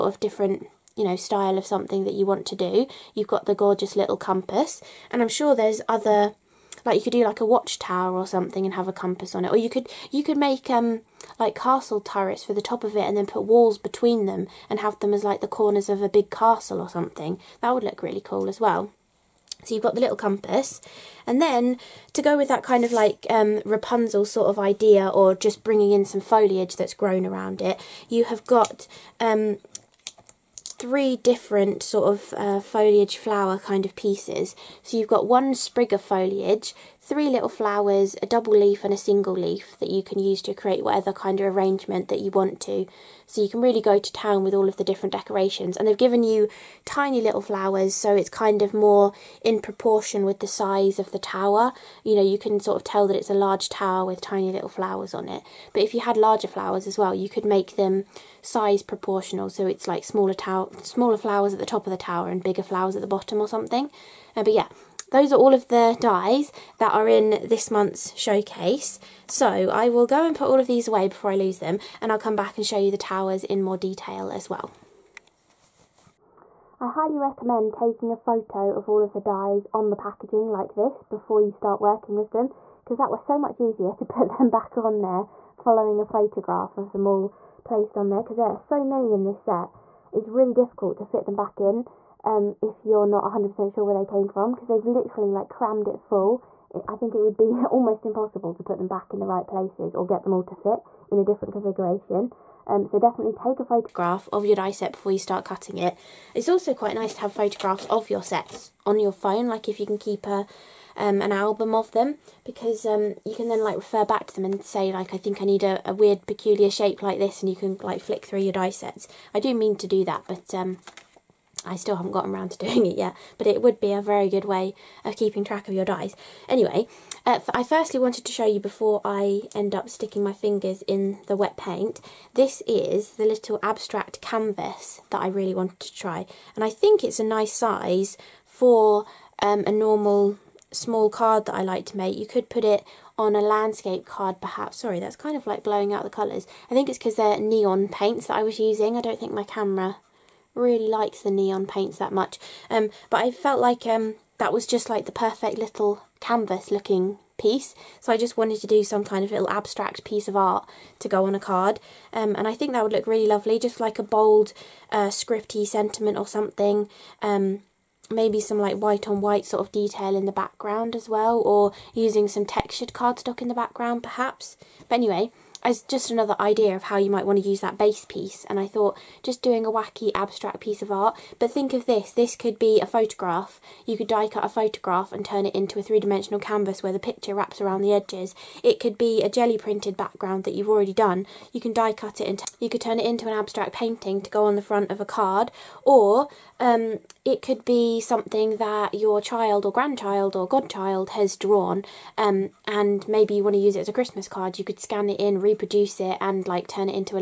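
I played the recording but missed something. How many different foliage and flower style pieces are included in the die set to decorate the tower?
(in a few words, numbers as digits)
3.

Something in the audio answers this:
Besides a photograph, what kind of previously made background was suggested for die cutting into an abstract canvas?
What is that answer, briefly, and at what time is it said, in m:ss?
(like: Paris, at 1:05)
Jelly printed background, at 3:09.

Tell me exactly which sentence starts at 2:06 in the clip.
Anyway uh, I firstly wanted to show you before I end up sticking my fingers in the wet paint.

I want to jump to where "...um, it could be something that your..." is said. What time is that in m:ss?
3:16.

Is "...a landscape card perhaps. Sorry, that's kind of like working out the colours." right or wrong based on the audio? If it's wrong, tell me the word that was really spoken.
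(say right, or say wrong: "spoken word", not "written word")
wrong: "blowing", not "working".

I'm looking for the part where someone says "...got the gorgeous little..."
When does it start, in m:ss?
0:03.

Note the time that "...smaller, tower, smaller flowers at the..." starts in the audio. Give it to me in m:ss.
1:00.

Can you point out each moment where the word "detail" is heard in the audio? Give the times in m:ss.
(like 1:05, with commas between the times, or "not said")
1:13, 2:49.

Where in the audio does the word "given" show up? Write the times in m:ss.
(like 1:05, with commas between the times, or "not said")
0:45.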